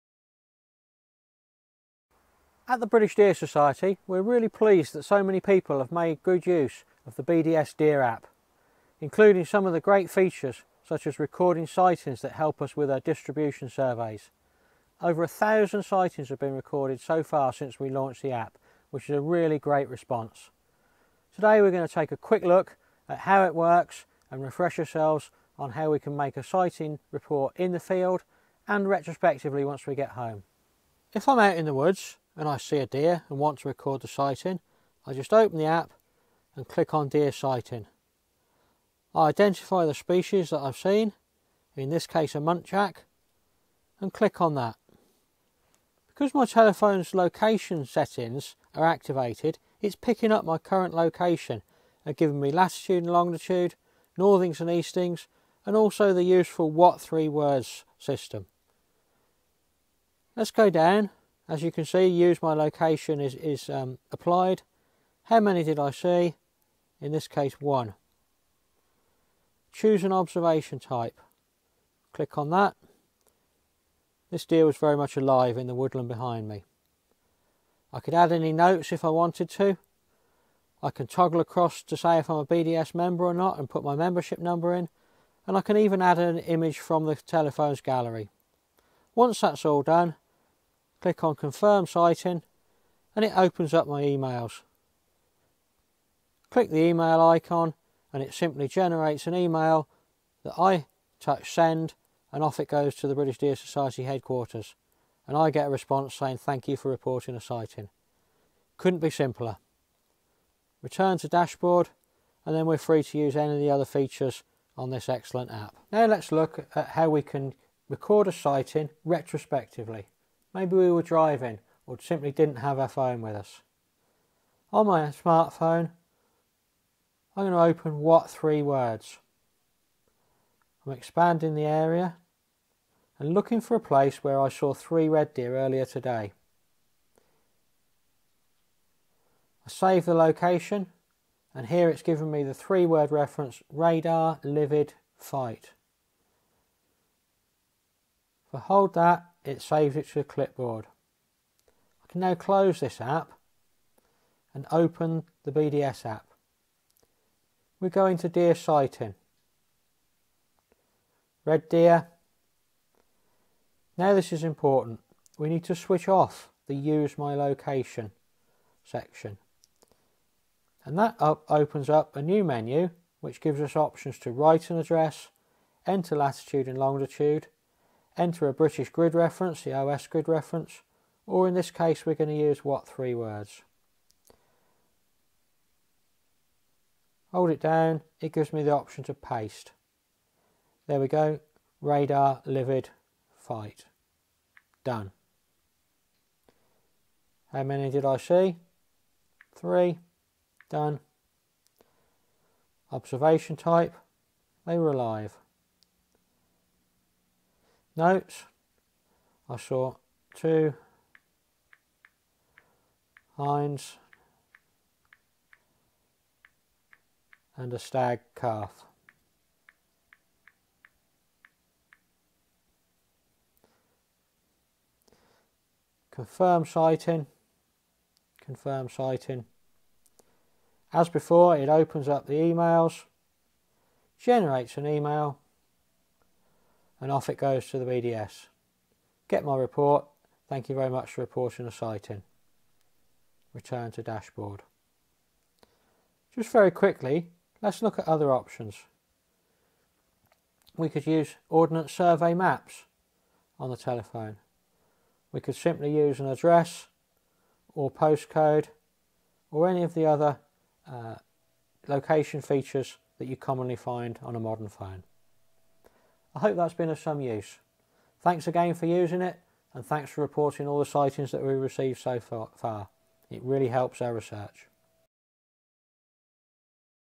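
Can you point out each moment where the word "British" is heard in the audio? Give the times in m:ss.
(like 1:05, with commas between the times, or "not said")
0:02, 1:43, 2:58.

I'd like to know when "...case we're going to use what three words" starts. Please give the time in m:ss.
3:01.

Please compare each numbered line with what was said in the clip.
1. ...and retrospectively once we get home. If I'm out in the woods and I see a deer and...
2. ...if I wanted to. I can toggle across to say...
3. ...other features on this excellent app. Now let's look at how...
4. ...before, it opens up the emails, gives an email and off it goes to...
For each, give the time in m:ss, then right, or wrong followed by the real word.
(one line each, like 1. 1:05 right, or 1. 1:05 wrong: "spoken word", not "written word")
1. 0:28 right
2. 1:18 right
3. 1:53 right
4. 3:51 wrong: "generates", not "gives".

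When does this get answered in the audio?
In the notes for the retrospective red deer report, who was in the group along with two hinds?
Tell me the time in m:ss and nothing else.
3:37.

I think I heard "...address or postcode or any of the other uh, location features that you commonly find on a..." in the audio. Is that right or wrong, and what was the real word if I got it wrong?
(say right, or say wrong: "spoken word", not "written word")
right.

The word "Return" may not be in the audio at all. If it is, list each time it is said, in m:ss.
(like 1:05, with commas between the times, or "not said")
1:50, 4:03.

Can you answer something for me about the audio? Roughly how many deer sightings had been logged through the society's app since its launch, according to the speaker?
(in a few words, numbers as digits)
Over a thousand.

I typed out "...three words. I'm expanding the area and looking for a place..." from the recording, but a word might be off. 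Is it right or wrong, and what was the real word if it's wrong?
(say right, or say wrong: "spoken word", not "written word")
right.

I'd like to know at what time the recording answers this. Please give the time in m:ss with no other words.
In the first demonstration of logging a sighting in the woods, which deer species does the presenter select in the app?
0:42.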